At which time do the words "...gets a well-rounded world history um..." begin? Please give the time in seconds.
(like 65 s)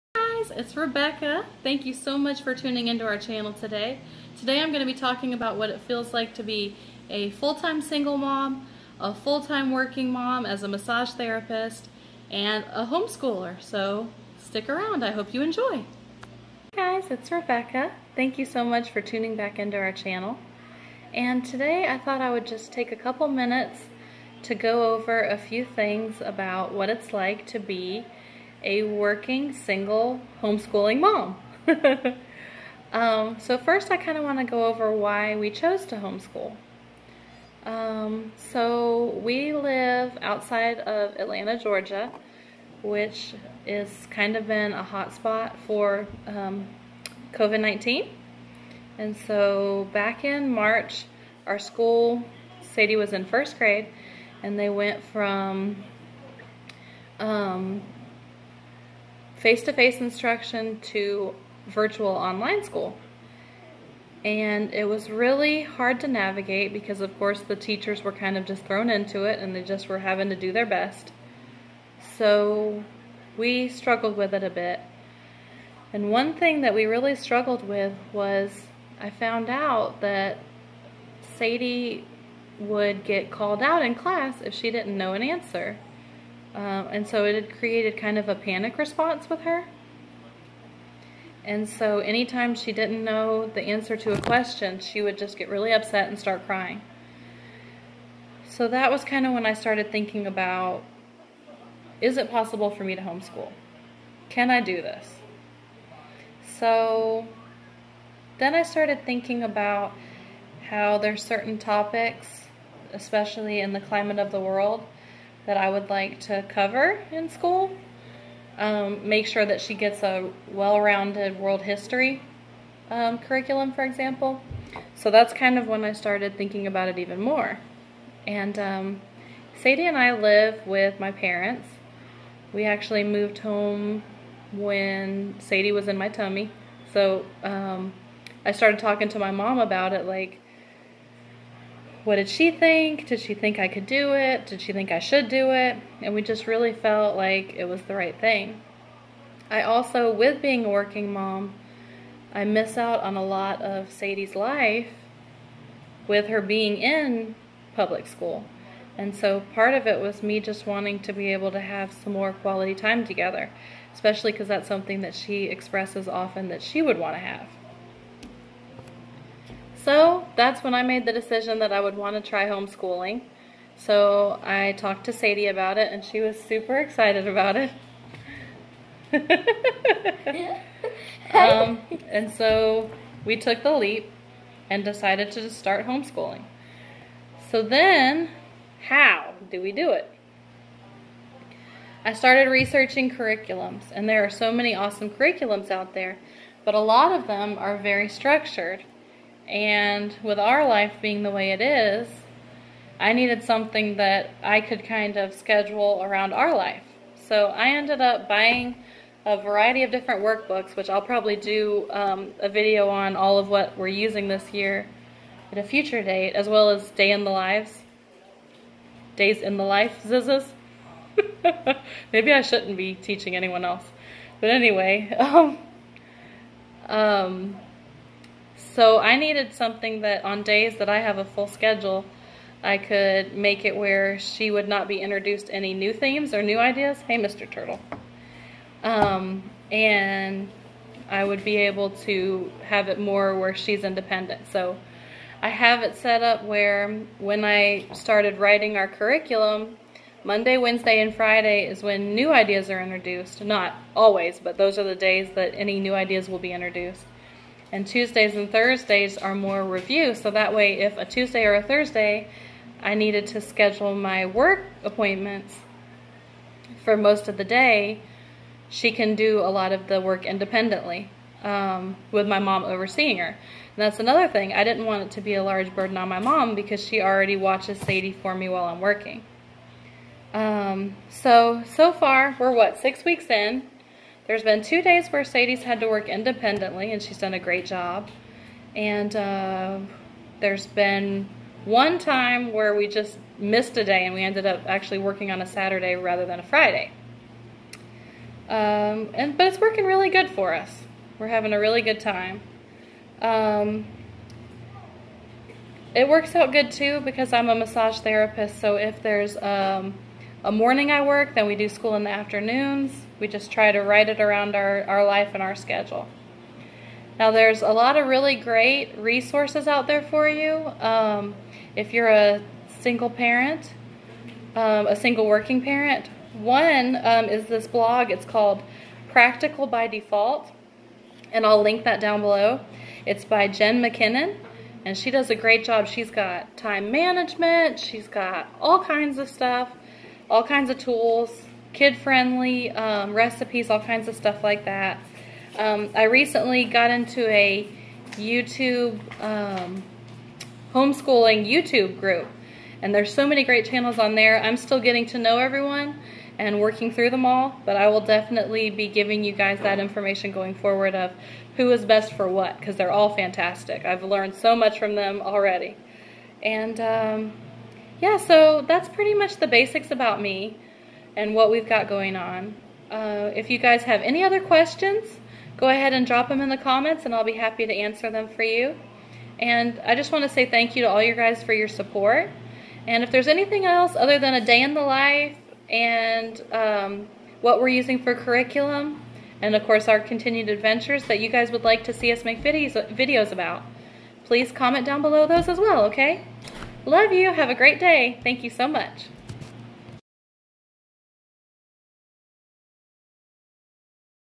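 119 s.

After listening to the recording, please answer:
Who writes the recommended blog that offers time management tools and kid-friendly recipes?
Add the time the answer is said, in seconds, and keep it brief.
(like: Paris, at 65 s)
Jen McKinnon, at 333 s.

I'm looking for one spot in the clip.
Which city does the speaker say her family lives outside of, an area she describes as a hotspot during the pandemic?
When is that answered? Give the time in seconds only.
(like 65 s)
41 s.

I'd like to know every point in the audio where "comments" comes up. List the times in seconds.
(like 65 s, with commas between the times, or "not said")
376 s, 394 s.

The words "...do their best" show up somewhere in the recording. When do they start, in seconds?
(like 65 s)
70 s.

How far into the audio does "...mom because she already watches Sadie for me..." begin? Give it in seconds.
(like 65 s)
276 s.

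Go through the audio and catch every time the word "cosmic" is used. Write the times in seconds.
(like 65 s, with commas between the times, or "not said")
not said.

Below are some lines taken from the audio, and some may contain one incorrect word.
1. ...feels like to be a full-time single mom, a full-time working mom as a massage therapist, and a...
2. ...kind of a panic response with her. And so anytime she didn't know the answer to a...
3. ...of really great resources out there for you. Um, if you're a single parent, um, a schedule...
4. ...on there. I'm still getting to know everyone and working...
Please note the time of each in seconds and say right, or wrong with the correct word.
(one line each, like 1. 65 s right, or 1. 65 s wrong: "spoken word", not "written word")
1. 5 s right
2. 87 s right
3. 317 s wrong: "single", not "schedule"
4. 353 s right.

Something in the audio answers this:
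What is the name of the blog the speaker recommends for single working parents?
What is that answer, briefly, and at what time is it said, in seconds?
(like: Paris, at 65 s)
Practical by Default, at 329 s.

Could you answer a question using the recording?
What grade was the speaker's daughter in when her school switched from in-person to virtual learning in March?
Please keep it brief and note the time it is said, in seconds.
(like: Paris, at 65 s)
First grade, at 53 s.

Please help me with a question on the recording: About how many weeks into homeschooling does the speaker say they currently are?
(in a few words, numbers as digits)
6.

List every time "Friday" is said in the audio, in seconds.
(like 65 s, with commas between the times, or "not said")
251 s, 296 s.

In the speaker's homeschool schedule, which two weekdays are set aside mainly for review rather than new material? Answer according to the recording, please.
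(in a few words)
Tuesdays and Thursdays.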